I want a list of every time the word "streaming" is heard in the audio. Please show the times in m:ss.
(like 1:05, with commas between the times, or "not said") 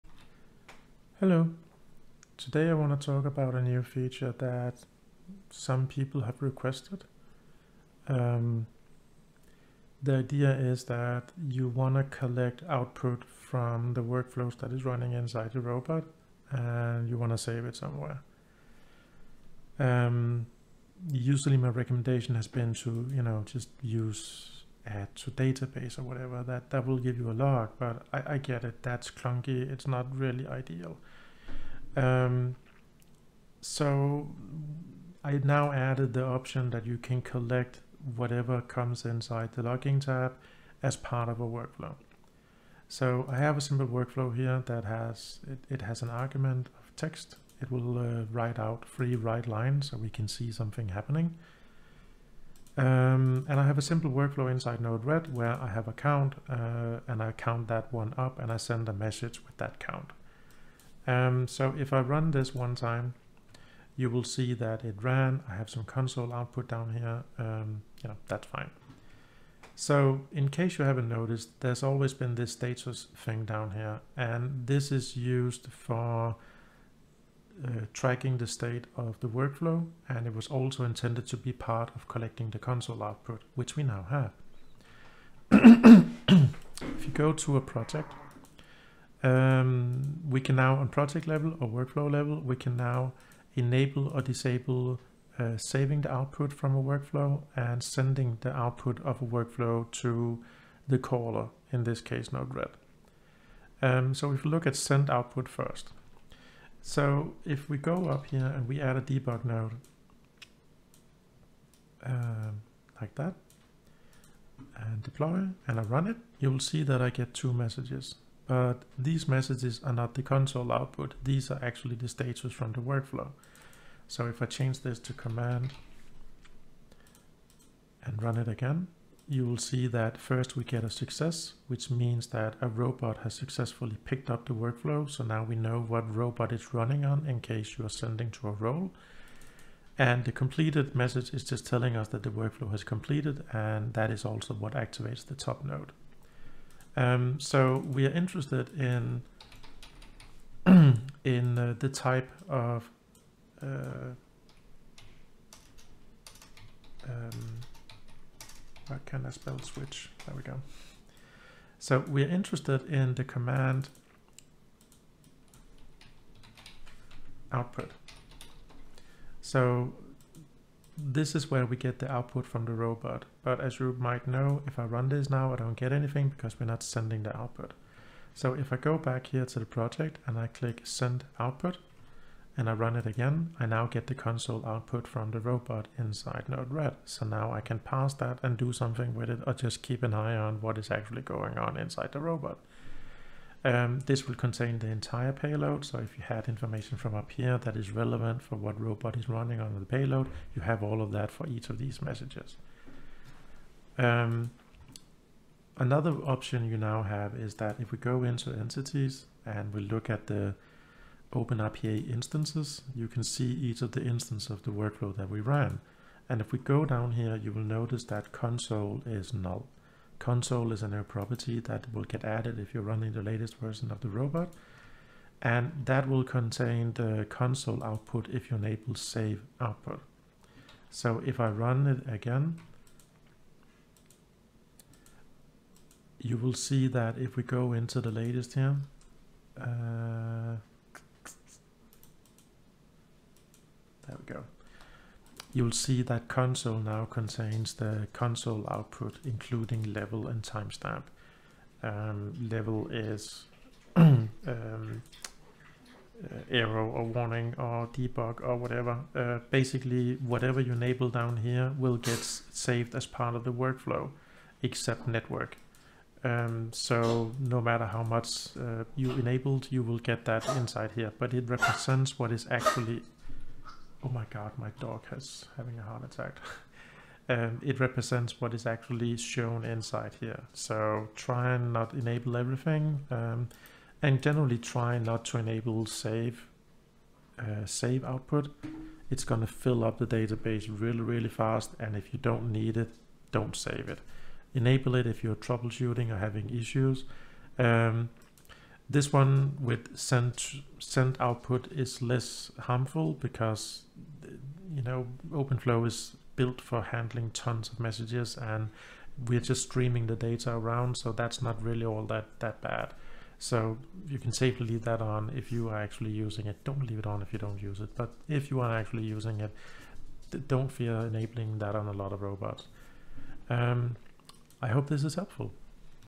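5:09.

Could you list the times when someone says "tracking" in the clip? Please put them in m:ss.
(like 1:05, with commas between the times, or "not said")
1:17.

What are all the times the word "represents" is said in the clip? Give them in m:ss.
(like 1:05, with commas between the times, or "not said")
4:31, 4:37.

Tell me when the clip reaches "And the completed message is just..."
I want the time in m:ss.
2:19.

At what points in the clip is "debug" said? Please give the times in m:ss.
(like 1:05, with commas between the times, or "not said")
1:49, 4:17.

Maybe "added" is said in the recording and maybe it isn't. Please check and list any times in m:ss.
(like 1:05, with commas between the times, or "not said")
0:35, 3:42.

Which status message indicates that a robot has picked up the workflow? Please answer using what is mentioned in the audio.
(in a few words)
success.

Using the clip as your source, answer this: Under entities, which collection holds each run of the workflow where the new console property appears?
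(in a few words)
Open RPA instances.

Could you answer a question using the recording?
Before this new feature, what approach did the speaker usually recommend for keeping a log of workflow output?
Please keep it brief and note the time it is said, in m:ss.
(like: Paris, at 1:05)
add to database, at 0:24.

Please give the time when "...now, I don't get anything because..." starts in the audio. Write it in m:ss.
2:55.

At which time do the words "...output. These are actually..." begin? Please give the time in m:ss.
2:00.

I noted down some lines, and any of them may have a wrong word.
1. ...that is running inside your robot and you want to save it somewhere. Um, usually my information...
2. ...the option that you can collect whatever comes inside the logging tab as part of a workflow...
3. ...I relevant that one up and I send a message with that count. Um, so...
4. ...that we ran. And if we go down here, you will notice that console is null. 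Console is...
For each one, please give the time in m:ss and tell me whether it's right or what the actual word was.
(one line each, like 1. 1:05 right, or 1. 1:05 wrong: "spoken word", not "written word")
1. 0:14 wrong: "recommendation", not "information"
2. 0:36 right
3. 0:57 wrong: "count", not "relevant"
4. 3:35 right.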